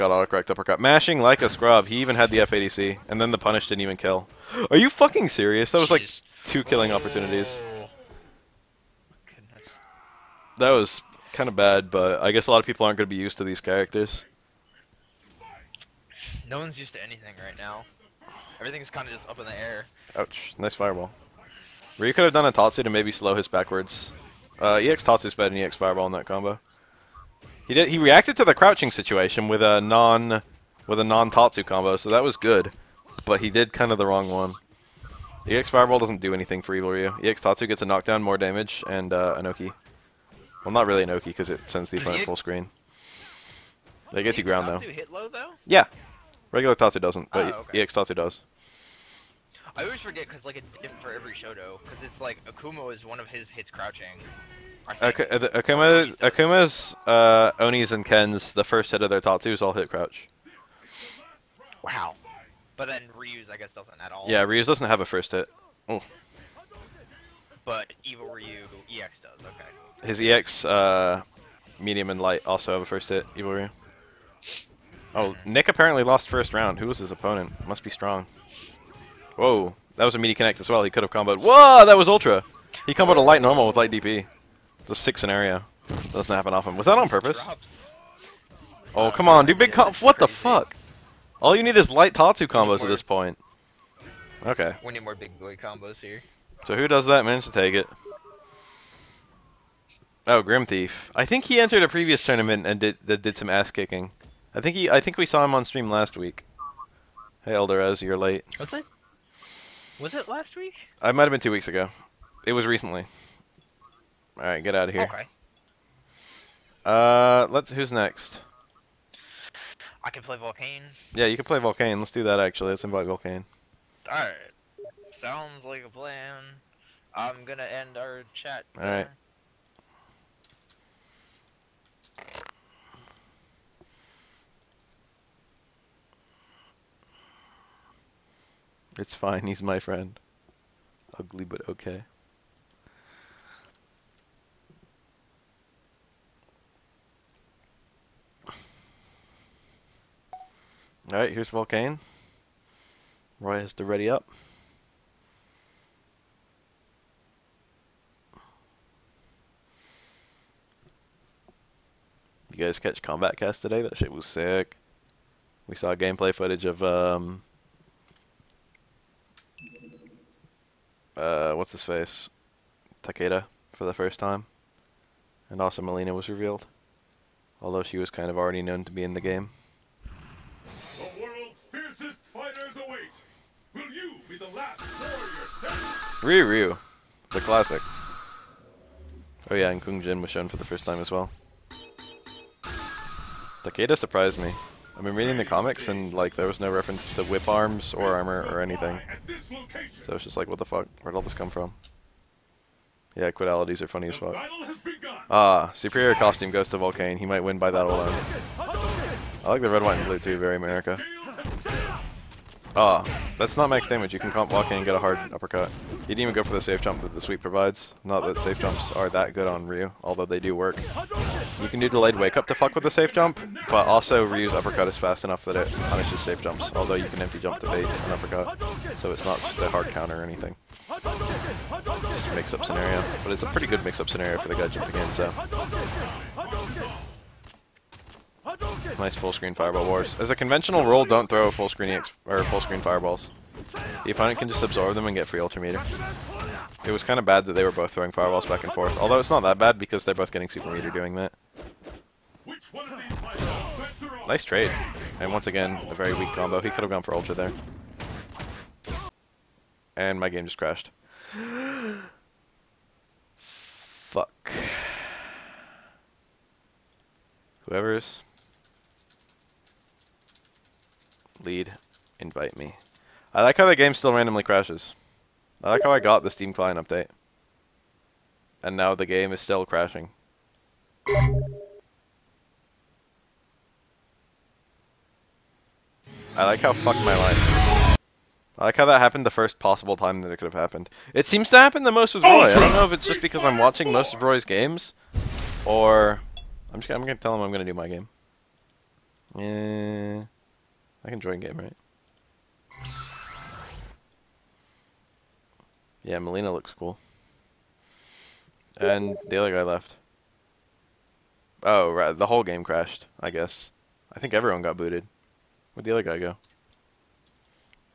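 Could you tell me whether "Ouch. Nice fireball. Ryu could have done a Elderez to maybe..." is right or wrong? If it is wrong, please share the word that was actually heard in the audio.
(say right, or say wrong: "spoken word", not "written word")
wrong: "Tatsu", not "Elderez".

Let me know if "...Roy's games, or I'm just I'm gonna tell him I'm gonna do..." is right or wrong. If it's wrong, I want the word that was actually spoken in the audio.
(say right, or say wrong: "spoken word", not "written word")
right.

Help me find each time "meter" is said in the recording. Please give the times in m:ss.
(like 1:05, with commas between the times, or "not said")
4:05, 4:10.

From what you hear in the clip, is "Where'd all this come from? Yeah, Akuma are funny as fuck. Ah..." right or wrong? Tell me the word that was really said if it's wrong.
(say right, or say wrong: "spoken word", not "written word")
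wrong: "Quitalities", not "Akuma".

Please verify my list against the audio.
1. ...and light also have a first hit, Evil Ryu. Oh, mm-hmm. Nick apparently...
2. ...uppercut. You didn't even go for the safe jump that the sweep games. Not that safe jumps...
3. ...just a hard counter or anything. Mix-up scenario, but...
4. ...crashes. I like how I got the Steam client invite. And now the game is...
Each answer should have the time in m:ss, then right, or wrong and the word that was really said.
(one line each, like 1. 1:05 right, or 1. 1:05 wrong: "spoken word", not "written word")
1. 1:12 right
2. 3:35 wrong: "provides", not "games"
3. 3:49 right
4. 4:34 wrong: "update", not "invite".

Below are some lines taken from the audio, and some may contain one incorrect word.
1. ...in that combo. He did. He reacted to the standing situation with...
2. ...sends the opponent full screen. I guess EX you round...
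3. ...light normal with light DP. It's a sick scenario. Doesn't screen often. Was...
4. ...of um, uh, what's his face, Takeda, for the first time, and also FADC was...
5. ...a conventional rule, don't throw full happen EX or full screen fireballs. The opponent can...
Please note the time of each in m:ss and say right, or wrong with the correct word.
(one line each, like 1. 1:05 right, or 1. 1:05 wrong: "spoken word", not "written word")
1. 0:26 wrong: "crouching", not "standing"
2. 0:41 wrong: "ground", not "round"
3. 1:23 wrong: "happen", not "screen"
4. 2:46 wrong: "Mileena", not "FADC"
5. 4:00 wrong: "screen", not "happen".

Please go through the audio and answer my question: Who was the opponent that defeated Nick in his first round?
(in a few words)
Grim Thief.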